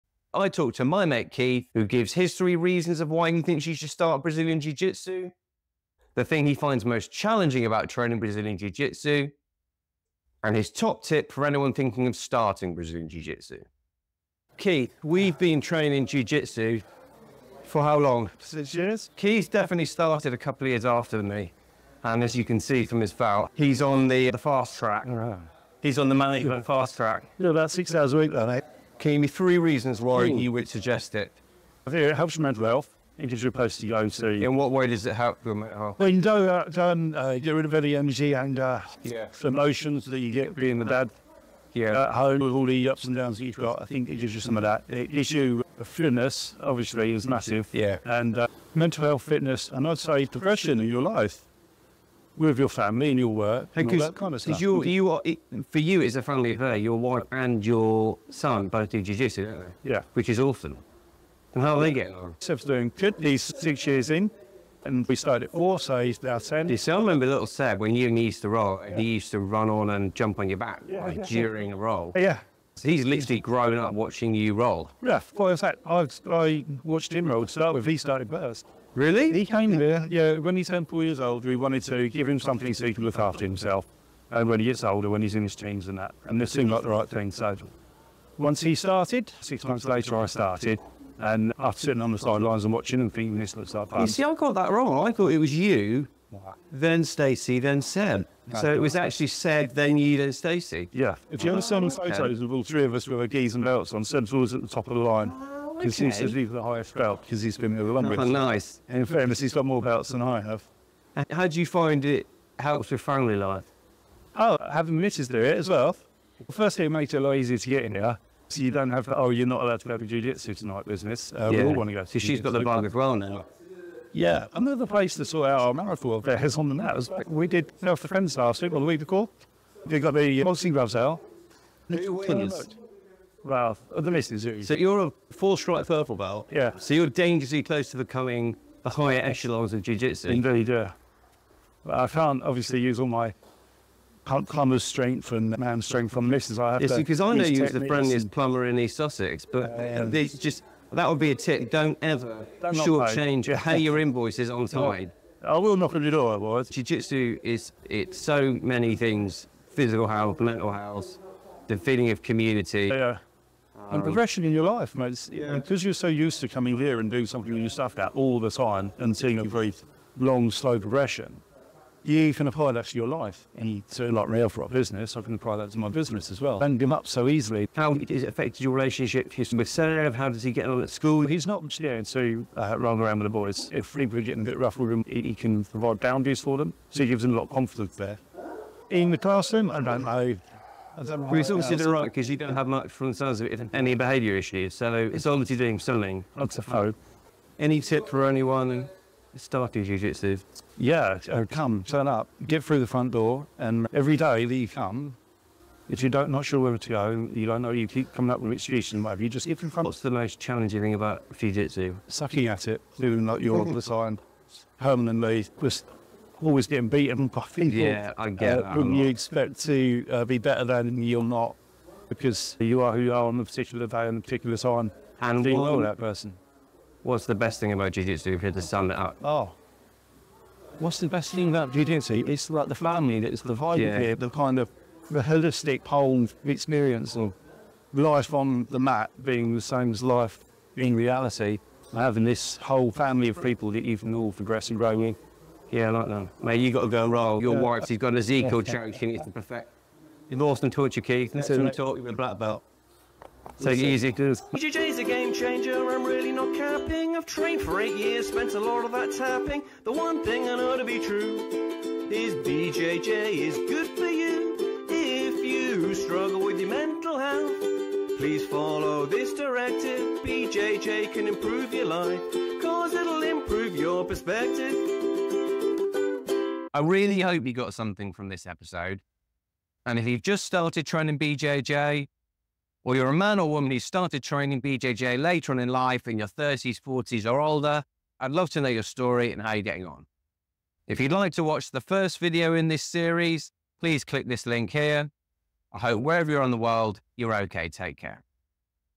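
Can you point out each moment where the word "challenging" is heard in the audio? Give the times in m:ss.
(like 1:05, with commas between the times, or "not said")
0:07, 3:30.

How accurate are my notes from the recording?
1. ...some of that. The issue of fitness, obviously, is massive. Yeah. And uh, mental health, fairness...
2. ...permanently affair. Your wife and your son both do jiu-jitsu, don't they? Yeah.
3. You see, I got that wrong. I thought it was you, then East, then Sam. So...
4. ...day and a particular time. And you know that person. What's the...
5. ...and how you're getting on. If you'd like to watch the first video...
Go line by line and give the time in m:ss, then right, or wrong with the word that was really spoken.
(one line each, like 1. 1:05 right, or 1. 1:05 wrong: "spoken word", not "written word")
1. 0:44 wrong: "fitness", not "fairness"
2. 0:56 wrong: "family", not "permanently"
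3. 1:34 wrong: "Stacey", not "East"
4. 3:43 right
5. 4:49 right.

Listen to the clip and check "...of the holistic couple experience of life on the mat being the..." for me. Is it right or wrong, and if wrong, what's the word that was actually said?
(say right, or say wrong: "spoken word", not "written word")
wrong: "whole", not "couple".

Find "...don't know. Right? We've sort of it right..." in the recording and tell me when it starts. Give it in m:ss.
3:09.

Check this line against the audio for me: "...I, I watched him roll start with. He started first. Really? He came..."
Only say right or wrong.
right.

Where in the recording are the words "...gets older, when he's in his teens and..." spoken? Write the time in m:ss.
1:24.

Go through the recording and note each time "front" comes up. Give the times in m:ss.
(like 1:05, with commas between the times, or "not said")
3:22, 3:29.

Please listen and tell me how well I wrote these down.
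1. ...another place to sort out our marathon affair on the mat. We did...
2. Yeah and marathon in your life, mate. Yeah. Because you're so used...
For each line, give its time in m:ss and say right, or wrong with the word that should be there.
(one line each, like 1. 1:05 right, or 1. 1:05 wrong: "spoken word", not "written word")
1. 2:04 right
2. 2:42 wrong: "progression", not "marathon".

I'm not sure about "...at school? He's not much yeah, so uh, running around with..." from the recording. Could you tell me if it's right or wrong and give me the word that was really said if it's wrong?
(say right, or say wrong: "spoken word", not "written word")
right.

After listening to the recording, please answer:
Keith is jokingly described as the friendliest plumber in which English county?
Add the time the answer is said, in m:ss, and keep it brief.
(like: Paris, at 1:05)
East Sussex, at 2:28.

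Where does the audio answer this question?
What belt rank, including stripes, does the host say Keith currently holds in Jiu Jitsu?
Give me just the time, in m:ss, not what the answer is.
2:15.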